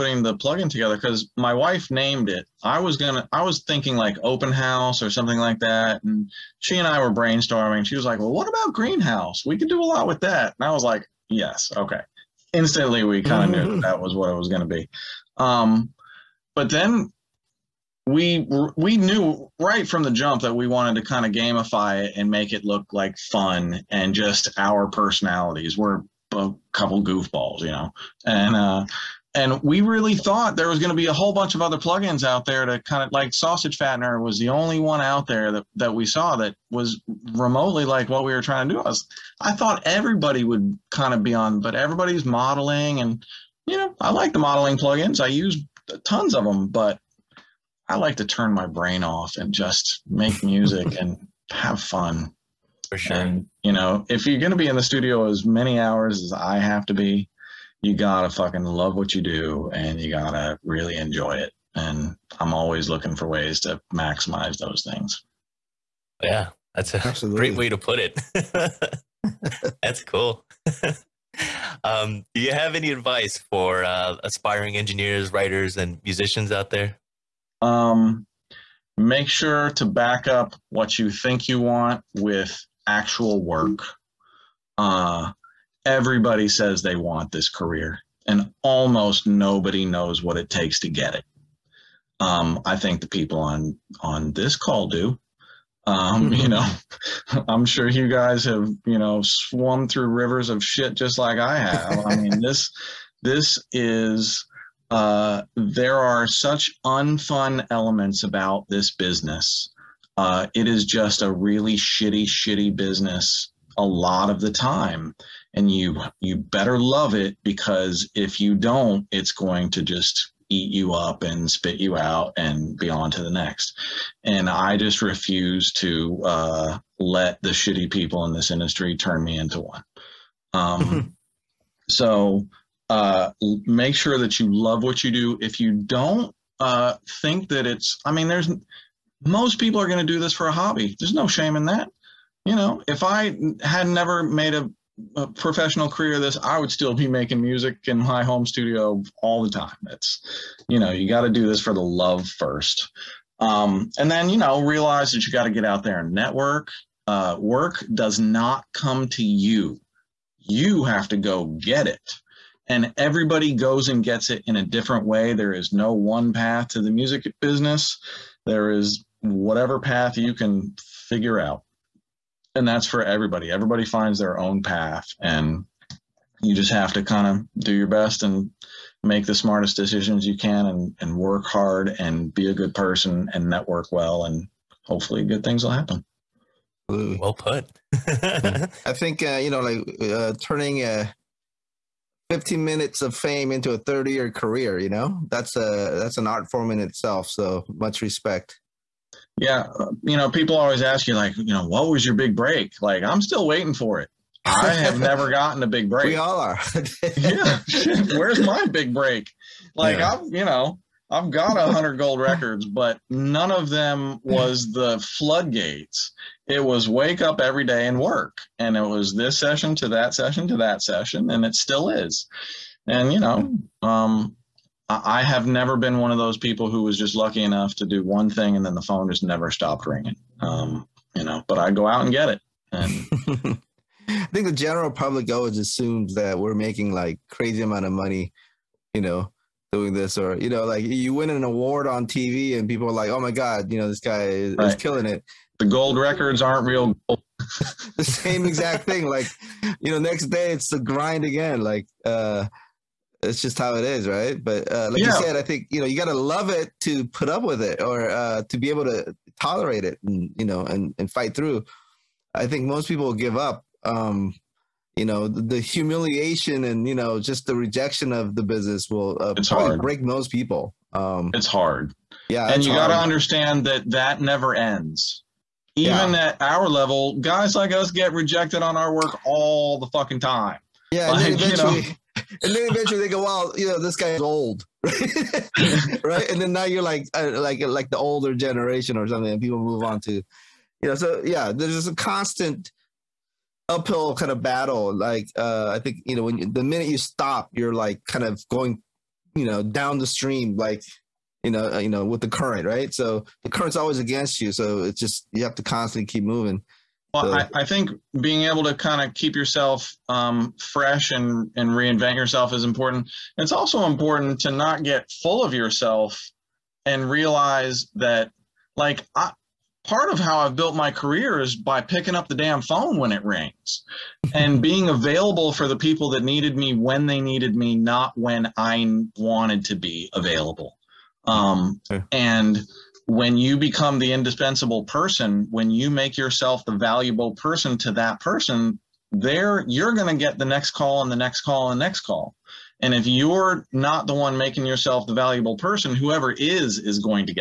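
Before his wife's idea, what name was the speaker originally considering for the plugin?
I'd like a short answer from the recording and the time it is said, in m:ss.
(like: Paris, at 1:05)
Open house, at 0:04.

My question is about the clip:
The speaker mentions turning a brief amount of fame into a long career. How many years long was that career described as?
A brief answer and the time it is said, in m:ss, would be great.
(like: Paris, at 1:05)
30, at 3:13.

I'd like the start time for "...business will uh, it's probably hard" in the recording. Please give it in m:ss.
4:28.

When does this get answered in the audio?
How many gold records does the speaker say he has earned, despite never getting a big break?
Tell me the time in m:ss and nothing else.
3:31.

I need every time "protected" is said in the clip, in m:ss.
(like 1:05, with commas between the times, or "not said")
not said.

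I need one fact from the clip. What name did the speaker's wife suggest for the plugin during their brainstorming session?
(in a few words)
Greenhouse.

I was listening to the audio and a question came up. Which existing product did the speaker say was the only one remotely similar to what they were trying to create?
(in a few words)
Sausage fattener.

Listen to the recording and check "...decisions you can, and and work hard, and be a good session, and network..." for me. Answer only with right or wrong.
wrong.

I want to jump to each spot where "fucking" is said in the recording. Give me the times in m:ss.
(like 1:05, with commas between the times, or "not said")
0:58, 4:39.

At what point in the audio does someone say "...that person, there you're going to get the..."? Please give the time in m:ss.
5:37.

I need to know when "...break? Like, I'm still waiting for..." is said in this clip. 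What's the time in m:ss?
3:22.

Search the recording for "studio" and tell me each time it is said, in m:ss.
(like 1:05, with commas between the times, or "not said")
0:54, 2:28.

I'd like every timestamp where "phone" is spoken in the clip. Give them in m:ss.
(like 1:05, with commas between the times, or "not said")
3:48, 5:22.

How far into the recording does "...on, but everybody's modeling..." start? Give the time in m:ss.
0:41.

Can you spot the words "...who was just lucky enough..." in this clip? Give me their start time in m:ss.
3:46.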